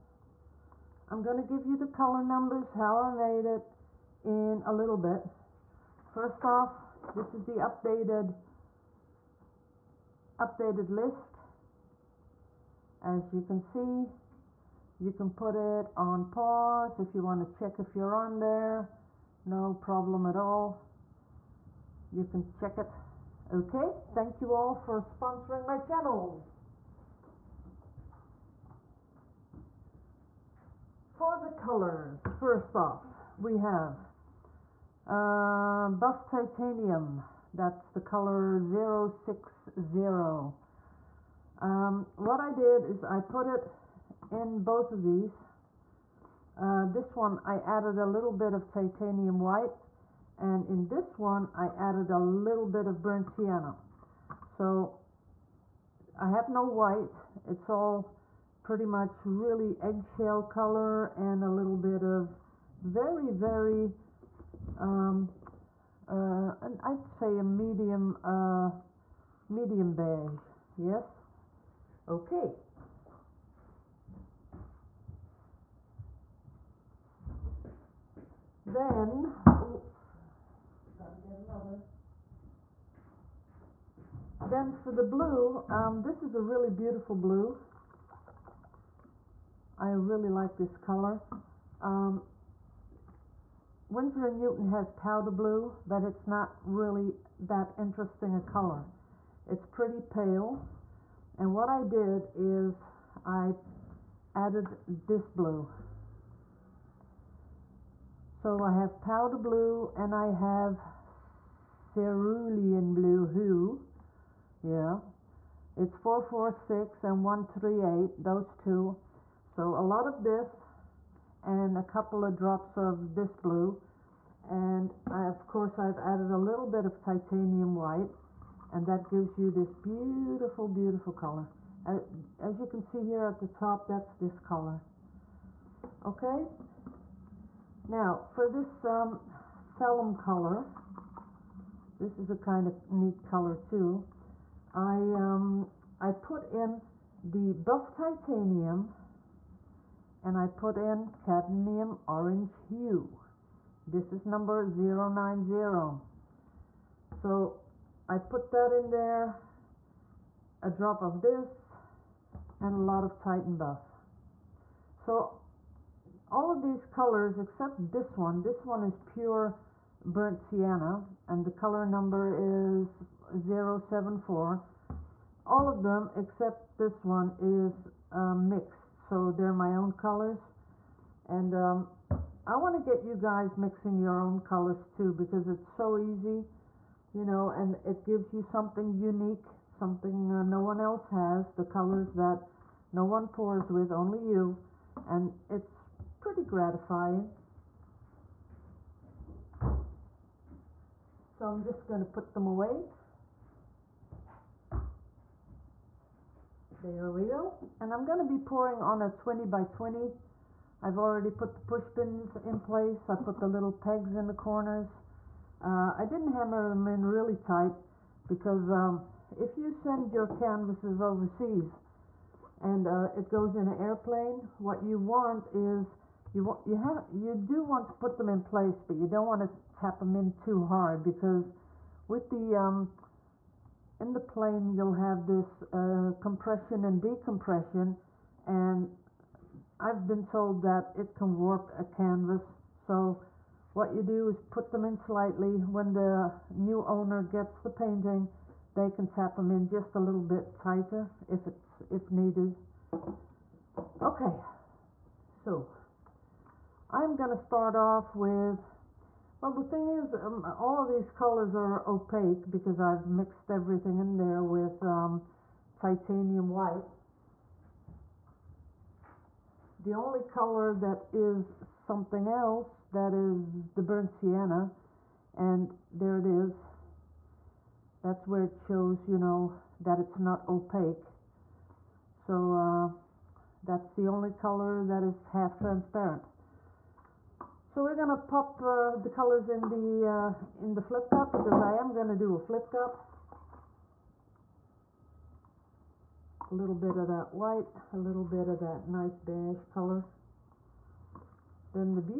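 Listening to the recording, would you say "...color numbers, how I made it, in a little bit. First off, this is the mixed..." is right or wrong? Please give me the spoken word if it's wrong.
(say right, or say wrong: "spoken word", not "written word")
wrong: "updated", not "mixed".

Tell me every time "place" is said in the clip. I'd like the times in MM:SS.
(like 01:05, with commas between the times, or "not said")
03:32, 03:48.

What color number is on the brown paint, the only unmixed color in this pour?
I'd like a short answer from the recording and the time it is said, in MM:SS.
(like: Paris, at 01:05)
074, at 02:53.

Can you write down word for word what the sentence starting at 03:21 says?
So I'm just going to put them away.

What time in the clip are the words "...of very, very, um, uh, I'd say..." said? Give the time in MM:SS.
01:02.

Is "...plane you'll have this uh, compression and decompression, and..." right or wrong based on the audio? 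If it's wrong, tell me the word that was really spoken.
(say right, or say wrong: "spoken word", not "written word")
right.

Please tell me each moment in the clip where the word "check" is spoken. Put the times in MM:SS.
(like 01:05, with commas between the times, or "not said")
00:17, 00:22.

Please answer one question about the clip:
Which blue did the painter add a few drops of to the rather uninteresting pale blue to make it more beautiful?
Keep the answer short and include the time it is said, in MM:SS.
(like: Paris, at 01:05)
cerulean blue hue, at 01:51.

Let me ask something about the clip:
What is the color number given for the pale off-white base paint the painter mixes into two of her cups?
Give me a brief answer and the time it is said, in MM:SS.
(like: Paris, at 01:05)
060, at 00:38.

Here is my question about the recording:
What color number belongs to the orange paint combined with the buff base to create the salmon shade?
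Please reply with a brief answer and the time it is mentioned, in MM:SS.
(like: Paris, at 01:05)
090, at 02:34.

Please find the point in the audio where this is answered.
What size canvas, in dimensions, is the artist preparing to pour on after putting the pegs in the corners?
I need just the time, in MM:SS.
03:29.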